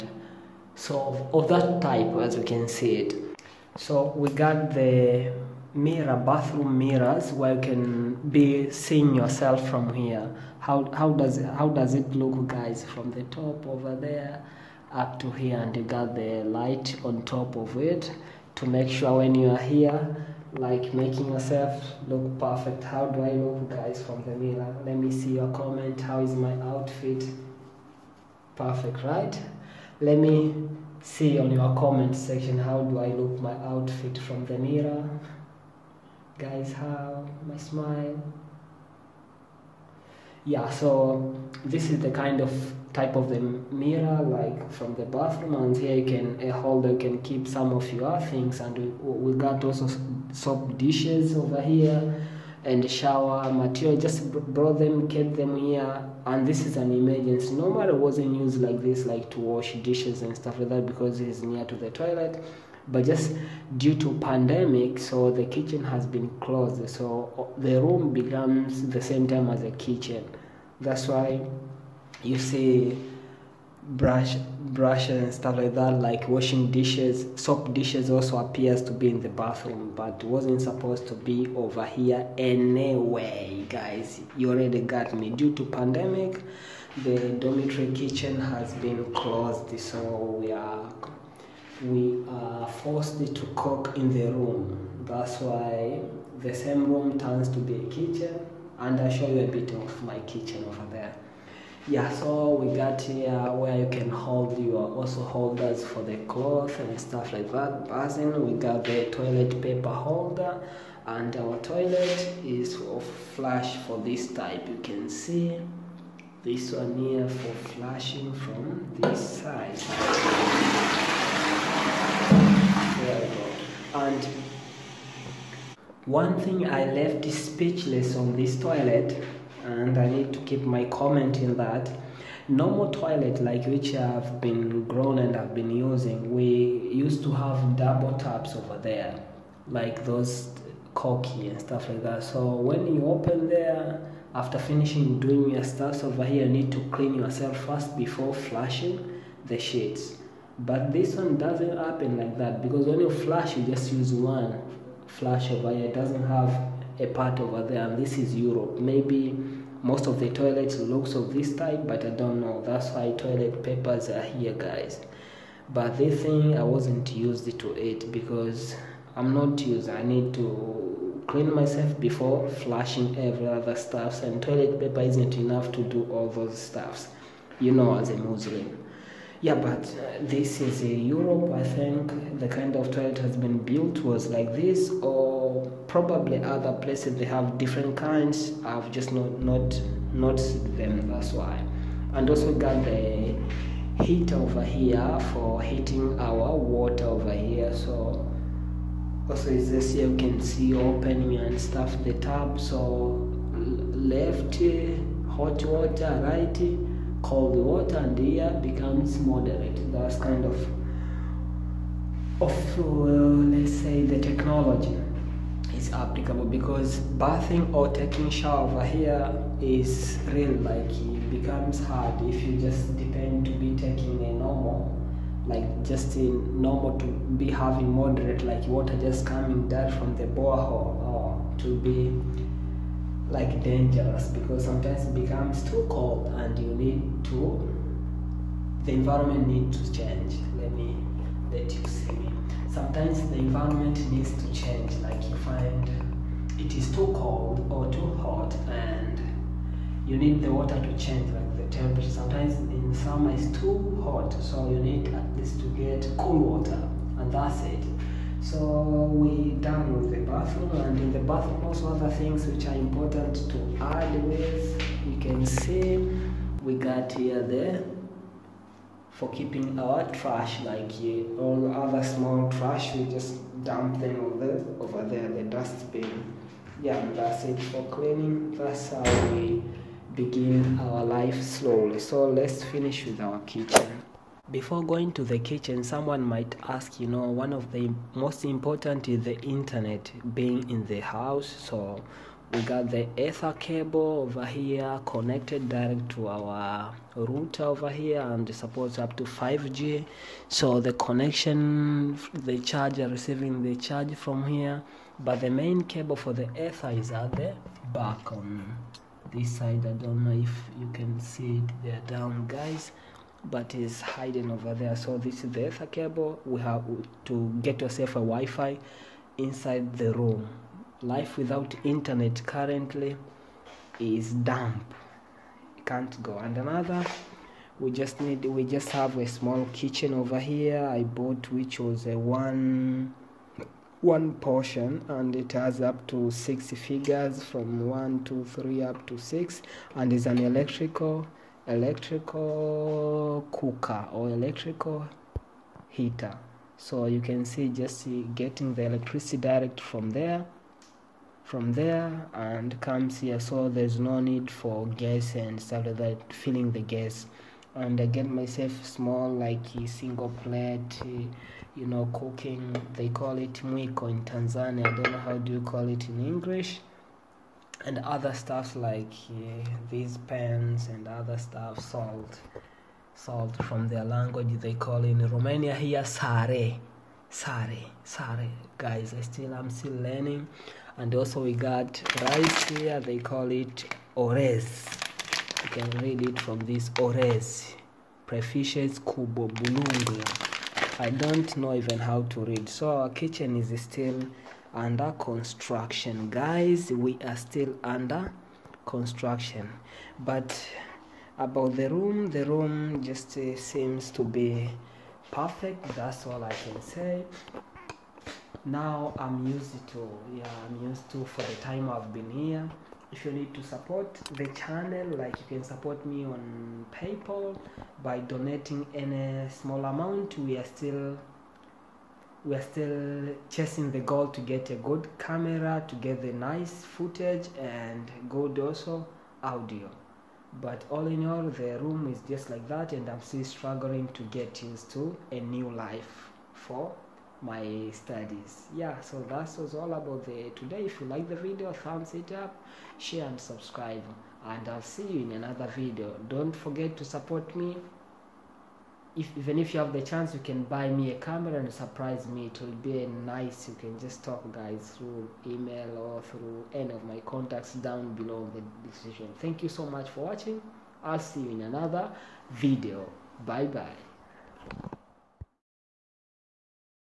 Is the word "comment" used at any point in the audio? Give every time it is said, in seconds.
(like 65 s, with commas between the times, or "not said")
25 s, 31 s, 130 s.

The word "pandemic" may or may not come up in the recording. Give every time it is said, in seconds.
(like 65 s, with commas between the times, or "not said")
64 s, 85 s.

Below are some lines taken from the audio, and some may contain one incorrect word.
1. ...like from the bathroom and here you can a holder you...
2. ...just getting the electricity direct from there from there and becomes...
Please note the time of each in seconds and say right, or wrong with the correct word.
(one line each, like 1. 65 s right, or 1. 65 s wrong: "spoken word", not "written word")
1. 44 s right
2. 347 s wrong: "comes", not "becomes".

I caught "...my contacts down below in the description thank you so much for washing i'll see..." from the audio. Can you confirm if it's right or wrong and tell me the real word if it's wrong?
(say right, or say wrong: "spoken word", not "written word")
wrong: "watching", not "washing".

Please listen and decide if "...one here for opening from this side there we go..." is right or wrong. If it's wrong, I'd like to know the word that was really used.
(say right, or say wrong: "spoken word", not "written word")
wrong: "flushing", not "opening".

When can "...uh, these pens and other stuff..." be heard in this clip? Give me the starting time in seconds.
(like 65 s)
369 s.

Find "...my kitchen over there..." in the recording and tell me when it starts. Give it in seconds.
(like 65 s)
100 s.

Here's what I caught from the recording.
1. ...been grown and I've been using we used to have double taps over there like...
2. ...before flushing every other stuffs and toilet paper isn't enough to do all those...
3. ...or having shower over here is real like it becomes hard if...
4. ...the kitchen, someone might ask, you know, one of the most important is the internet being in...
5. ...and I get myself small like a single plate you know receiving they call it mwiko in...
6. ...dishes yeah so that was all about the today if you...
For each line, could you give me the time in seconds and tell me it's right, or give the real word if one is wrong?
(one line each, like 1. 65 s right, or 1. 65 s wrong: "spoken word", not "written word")
1. 134 s right
2. 171 s right
3. 217 s wrong: "taking", not "having"
4. 285 s right
5. 357 s wrong: "cooking", not "receiving"
6. 437 s wrong: "studies", not "dishes".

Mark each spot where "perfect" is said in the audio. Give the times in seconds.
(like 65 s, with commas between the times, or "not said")
22 s, 28 s, 405 s.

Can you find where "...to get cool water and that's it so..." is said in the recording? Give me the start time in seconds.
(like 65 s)
255 s.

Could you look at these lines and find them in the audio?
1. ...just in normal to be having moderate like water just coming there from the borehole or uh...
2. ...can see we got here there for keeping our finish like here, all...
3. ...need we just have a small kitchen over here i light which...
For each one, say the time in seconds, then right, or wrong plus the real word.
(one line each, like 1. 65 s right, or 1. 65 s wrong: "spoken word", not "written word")
1. 225 s right
2. 265 s wrong: "trash", not "finish"
3. 328 s wrong: "bought", not "light".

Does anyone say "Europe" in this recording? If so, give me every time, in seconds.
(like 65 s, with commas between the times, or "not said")
158 s, 180 s.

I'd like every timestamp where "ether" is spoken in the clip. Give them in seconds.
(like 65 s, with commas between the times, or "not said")
293 s, 306 s, 315 s.